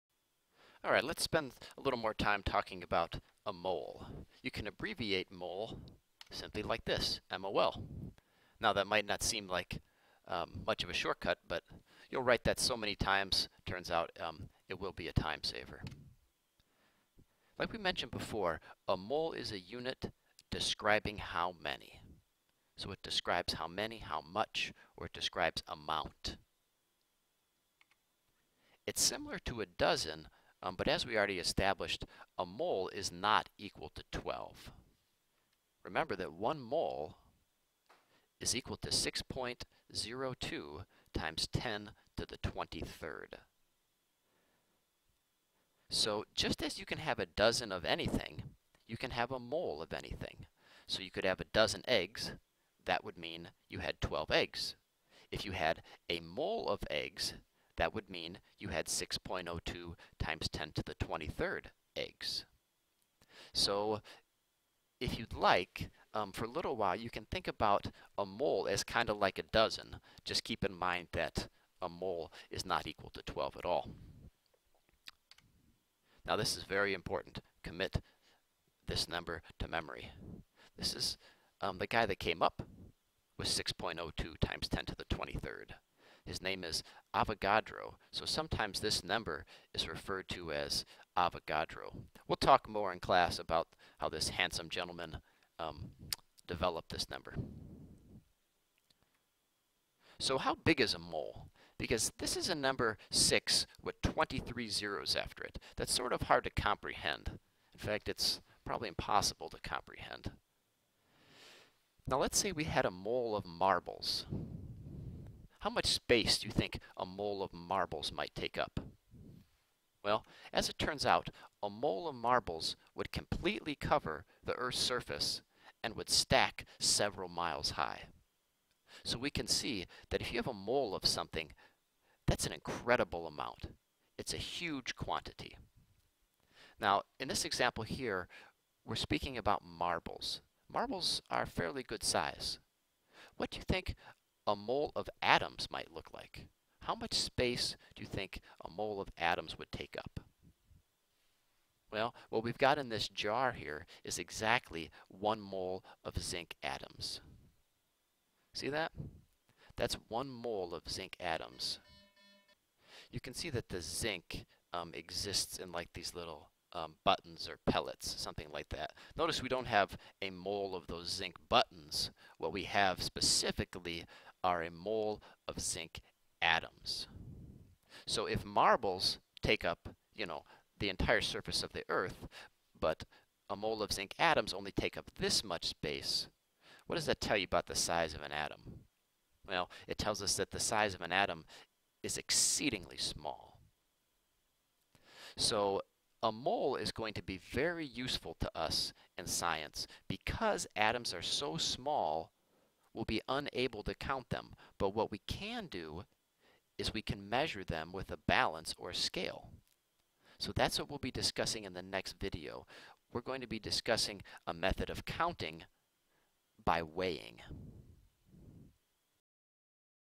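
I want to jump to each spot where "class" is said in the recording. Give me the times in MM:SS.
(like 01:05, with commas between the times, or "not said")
01:32.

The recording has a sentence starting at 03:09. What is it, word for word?
Well, it tells us that the size of an atom is exceedingly small.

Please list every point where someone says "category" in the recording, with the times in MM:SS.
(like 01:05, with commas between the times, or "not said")
not said.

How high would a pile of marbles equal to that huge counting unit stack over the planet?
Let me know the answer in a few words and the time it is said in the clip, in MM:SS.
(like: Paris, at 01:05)
several miles high, at 02:06.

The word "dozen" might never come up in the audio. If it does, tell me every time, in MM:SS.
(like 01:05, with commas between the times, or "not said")
00:29, 00:47, 00:51, 01:09.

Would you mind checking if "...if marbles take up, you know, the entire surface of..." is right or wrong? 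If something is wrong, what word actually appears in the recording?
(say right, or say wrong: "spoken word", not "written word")
right.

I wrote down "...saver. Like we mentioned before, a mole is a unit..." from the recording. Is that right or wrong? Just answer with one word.
right.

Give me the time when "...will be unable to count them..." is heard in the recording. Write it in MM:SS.
03:22.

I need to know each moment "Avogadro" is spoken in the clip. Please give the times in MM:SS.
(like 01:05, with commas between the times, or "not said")
01:27, 01:31.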